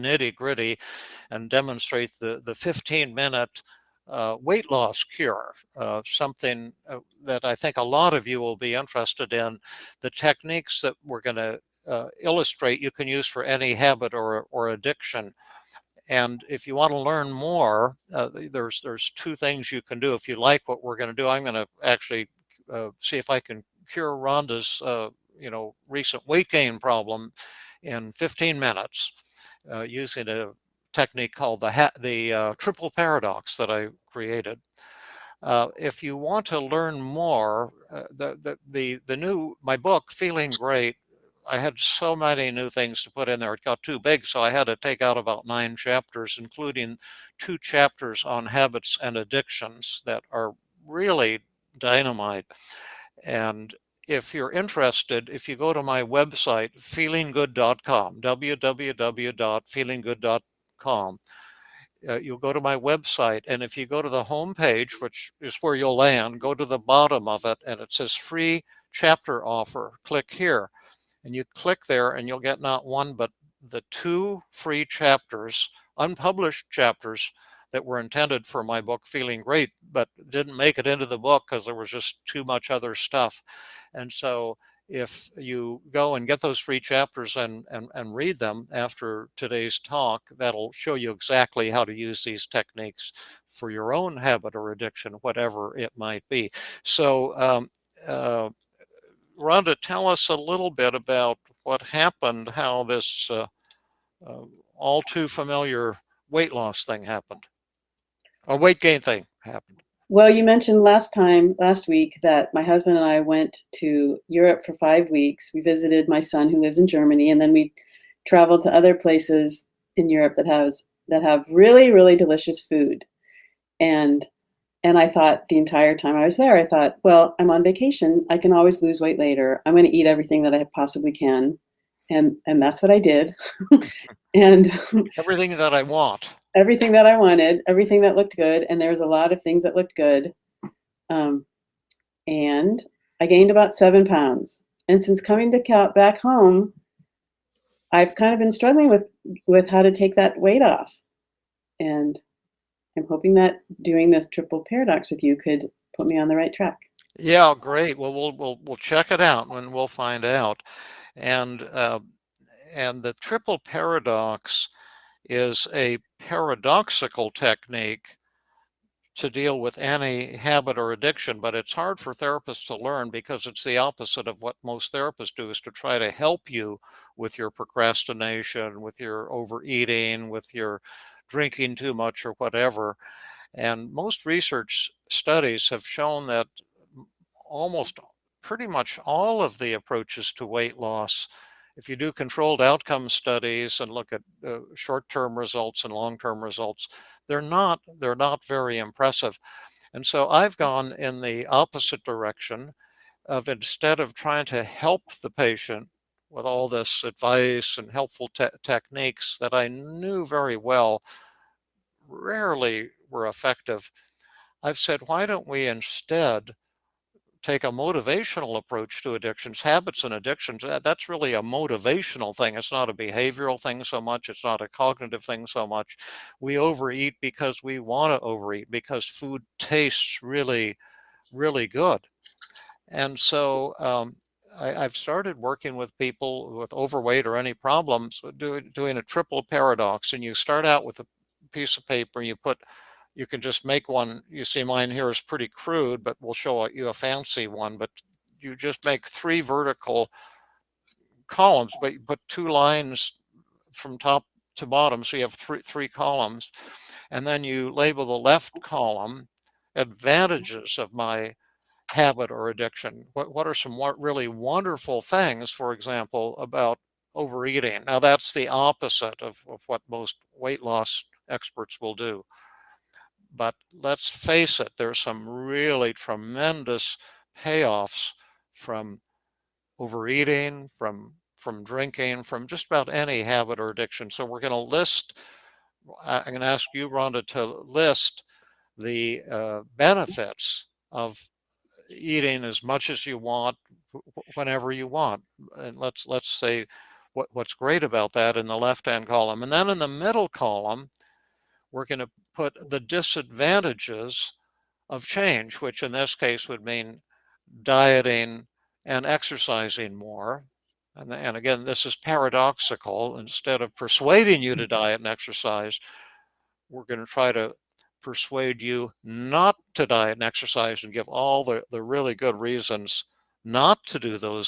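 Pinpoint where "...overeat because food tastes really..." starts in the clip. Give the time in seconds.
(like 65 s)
228 s.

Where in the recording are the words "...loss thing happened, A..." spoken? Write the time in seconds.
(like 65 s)
106 s.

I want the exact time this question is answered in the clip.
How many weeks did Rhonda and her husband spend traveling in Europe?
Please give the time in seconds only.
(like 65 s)
114 s.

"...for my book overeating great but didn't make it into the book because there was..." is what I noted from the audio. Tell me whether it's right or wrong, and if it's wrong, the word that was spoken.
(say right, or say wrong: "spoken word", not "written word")
wrong: "feeling", not "overeating".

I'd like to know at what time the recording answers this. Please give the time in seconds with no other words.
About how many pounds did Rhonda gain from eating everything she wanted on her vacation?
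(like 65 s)
143 s.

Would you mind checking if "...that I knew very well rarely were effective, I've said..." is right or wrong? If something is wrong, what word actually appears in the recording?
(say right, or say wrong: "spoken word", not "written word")
right.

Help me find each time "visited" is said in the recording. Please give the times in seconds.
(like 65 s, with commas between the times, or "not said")
115 s.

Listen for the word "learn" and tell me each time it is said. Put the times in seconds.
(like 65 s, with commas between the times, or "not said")
16 s, 36 s, 172 s.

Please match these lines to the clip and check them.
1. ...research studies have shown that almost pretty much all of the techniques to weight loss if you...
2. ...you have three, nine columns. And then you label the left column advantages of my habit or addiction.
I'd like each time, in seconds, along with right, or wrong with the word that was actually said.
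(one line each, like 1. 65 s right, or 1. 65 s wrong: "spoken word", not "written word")
1. 184 s wrong: "approaches", not "techniques"
2. 255 s wrong: "three", not "nine".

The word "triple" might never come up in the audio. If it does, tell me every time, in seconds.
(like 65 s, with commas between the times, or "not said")
32 s, 154 s, 163 s, 239 s.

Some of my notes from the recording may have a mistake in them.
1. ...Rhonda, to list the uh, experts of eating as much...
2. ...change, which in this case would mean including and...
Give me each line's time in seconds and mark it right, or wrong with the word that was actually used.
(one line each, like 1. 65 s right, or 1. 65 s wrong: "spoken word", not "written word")
1. 286 s wrong: "benefits", not "experts"
2. 305 s wrong: "dieting", not "including".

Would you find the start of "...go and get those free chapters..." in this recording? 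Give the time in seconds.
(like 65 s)
85 s.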